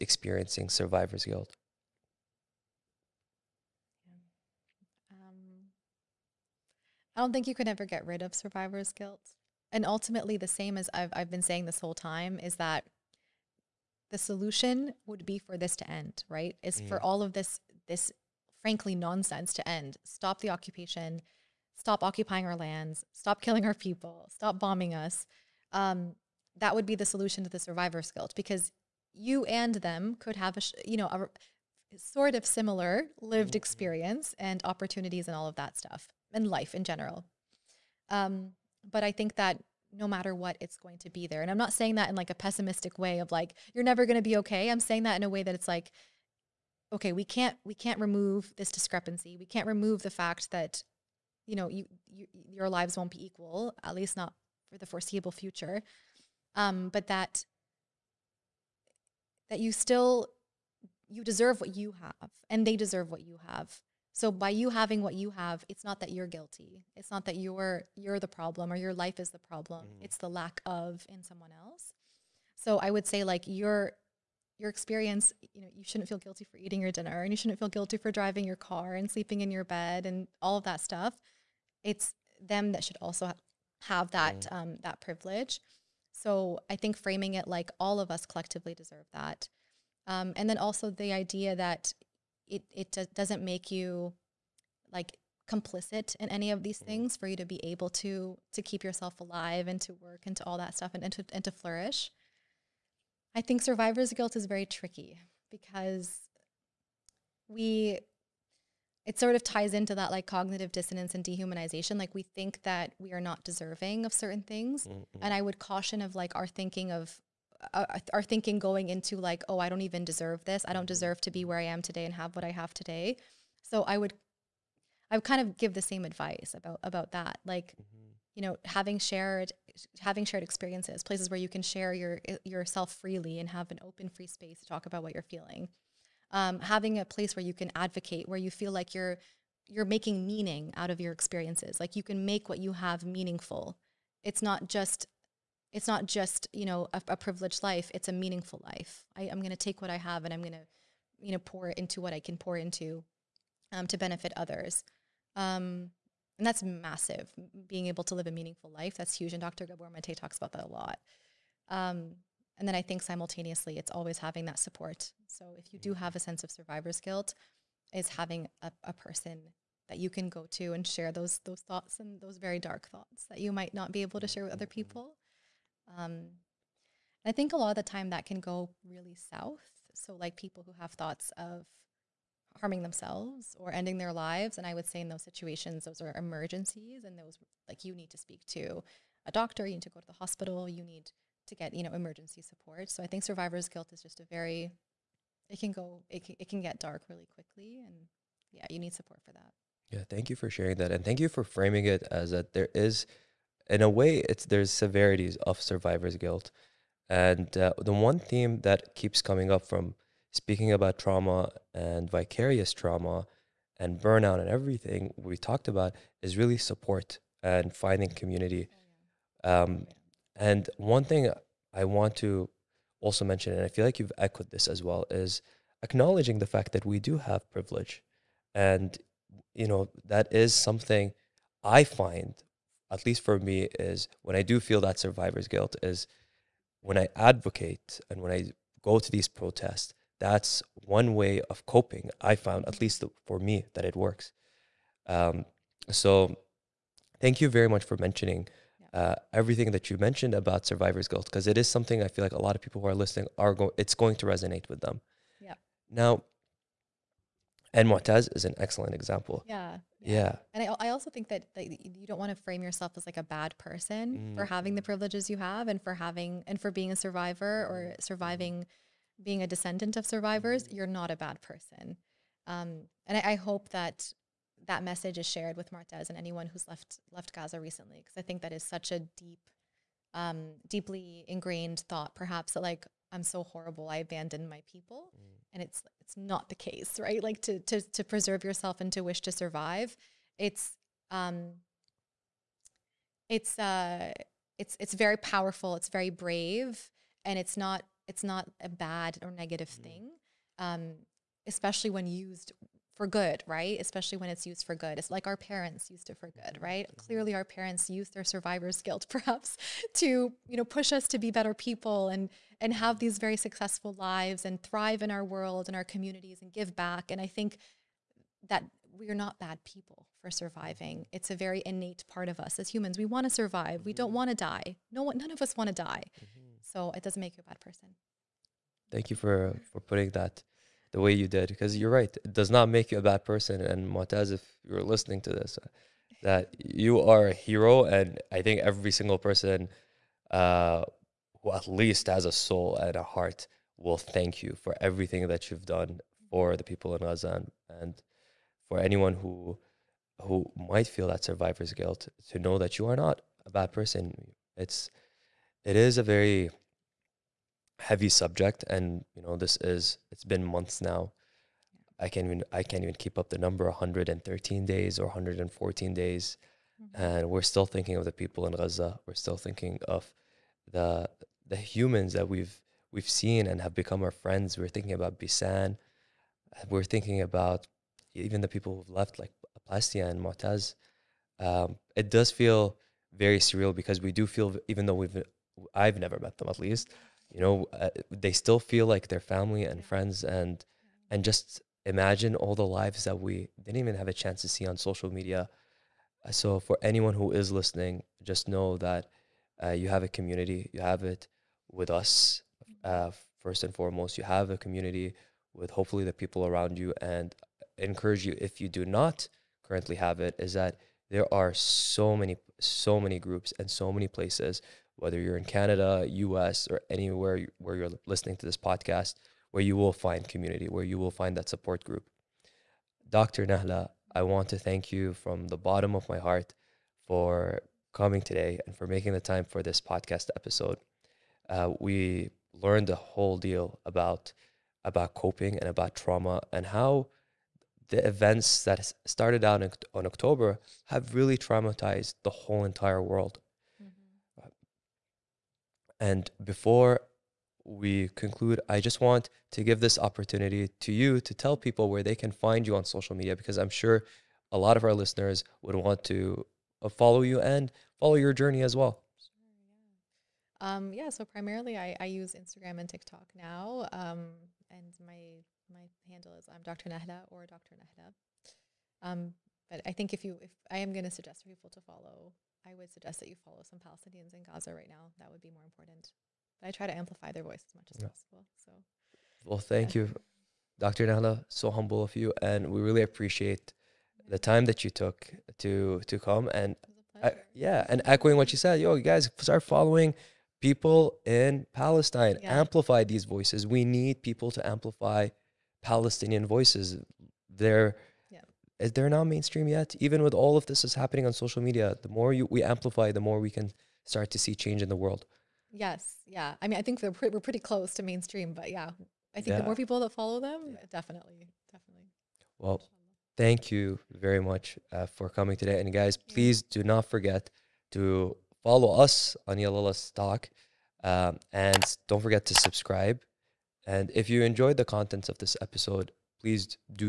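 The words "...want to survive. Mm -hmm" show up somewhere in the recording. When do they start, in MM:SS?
05:23.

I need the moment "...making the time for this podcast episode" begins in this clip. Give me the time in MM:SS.
07:08.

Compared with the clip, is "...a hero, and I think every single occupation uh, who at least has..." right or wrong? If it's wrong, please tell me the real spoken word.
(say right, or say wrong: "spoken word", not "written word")
wrong: "person", not "occupation".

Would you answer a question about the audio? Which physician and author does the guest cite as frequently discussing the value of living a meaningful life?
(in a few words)
Gabor Mate.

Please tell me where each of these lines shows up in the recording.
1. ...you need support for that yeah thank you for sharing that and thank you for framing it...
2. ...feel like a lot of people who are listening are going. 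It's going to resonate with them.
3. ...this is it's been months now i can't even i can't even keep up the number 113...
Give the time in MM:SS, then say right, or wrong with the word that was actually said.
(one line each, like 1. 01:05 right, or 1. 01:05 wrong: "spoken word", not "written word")
1. 03:18 right
2. 04:12 right
3. 05:59 right.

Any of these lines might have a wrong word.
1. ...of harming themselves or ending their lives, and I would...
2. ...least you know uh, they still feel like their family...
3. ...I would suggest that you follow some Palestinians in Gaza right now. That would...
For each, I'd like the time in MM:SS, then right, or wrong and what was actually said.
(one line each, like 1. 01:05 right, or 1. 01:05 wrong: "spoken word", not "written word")
1. 03:01 right
2. 06:26 right
3. 07:52 right.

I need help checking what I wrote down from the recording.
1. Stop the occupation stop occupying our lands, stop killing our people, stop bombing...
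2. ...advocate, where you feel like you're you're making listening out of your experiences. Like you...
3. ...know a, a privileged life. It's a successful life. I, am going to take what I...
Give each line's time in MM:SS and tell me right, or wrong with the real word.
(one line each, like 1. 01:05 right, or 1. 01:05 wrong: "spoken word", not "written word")
1. 00:20 right
2. 02:17 wrong: "meaning", not "listening"
3. 02:26 wrong: "meaningful", not "successful".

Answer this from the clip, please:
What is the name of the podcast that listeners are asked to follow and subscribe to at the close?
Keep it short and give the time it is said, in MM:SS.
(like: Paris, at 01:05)
Yalla Let's Talk, at 08:39.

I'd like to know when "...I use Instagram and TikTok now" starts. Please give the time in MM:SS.
07:41.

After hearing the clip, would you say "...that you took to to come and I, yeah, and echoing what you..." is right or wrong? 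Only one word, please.
right.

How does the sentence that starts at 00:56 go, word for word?
Um, but that that you still you deserve what you have and they deserve what you have.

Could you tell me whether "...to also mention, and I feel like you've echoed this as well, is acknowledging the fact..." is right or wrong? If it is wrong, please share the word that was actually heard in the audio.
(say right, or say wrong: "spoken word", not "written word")
right.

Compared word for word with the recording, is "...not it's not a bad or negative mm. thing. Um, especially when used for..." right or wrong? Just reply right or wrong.
right.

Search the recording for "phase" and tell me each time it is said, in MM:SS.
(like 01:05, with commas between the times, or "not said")
not said.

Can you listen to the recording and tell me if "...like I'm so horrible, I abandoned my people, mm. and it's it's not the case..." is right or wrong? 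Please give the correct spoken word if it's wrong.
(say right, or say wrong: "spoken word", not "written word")
right.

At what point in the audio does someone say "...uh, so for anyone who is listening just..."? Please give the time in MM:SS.
06:36.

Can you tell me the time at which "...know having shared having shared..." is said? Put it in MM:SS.
02:08.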